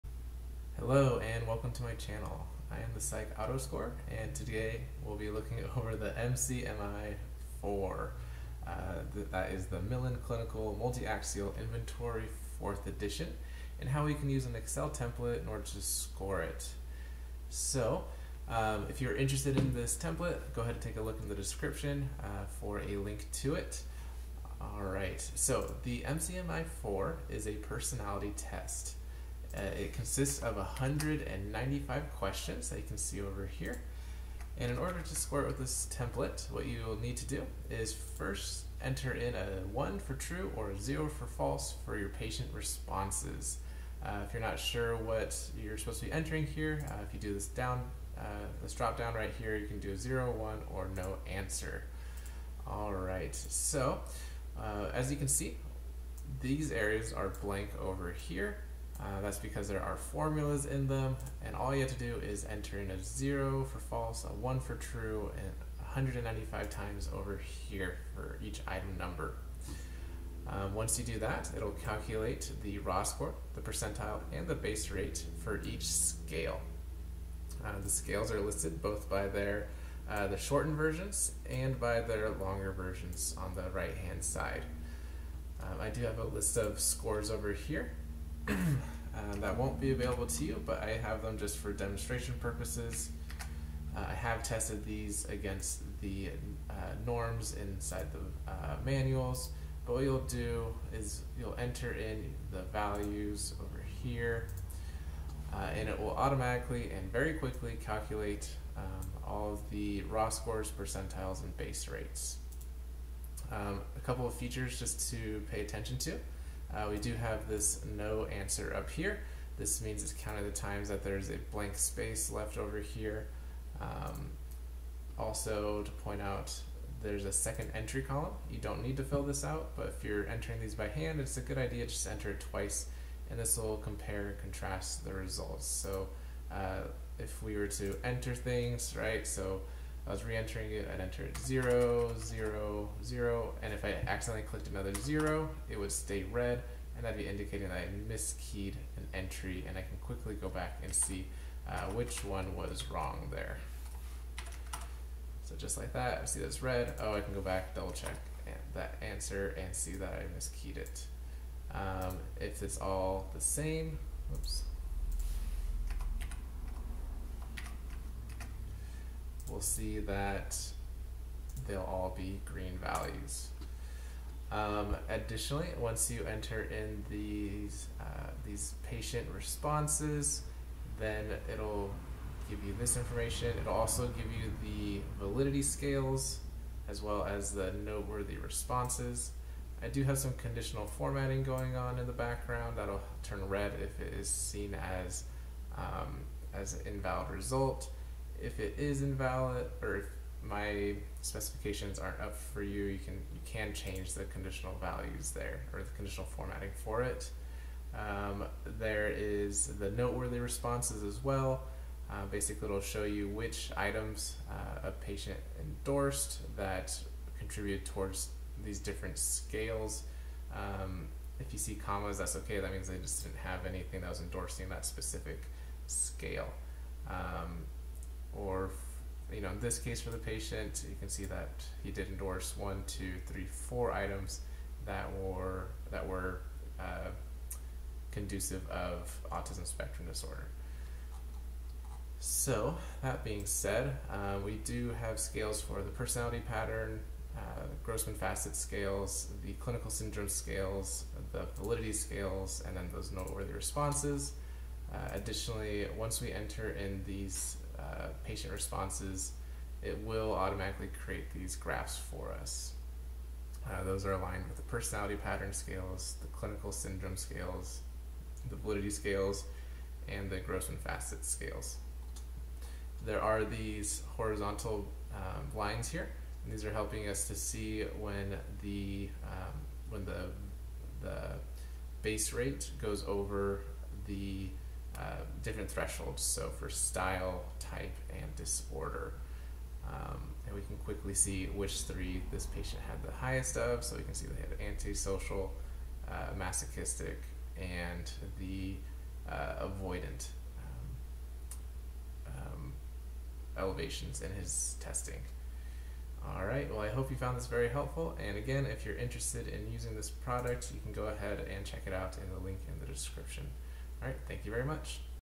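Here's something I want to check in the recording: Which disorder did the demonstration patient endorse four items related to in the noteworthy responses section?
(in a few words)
autism spectrum disorder.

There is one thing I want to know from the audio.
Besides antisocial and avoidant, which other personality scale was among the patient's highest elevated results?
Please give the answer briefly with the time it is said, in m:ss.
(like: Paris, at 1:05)
masochistic, at 4:56.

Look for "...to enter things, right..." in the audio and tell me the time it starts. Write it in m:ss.
2:17.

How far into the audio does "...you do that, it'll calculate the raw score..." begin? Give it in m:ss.
1:10.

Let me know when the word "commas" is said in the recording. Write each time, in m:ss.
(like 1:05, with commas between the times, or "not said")
3:41.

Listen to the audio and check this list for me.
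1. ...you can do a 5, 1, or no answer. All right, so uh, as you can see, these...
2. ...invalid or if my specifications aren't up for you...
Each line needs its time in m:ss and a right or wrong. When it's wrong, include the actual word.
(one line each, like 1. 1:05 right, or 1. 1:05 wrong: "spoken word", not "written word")
1. 0:49 wrong: "0", not "5"
2. 3:19 right.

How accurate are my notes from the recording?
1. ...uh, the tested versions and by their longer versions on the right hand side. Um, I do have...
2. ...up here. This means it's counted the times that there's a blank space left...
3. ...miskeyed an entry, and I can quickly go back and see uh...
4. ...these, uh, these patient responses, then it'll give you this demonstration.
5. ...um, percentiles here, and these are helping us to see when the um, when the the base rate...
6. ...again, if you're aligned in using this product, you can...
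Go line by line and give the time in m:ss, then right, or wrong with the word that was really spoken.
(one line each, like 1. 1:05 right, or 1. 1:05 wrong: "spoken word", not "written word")
1. 1:20 wrong: "shortened", not "tested"
2. 1:58 right
3. 2:28 right
4. 2:57 wrong: "information", not "demonstration"
5. 4:35 wrong: "lines", not "percentiles"
6. 5:08 wrong: "interested", not "aligned".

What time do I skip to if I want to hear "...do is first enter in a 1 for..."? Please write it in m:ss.
0:37.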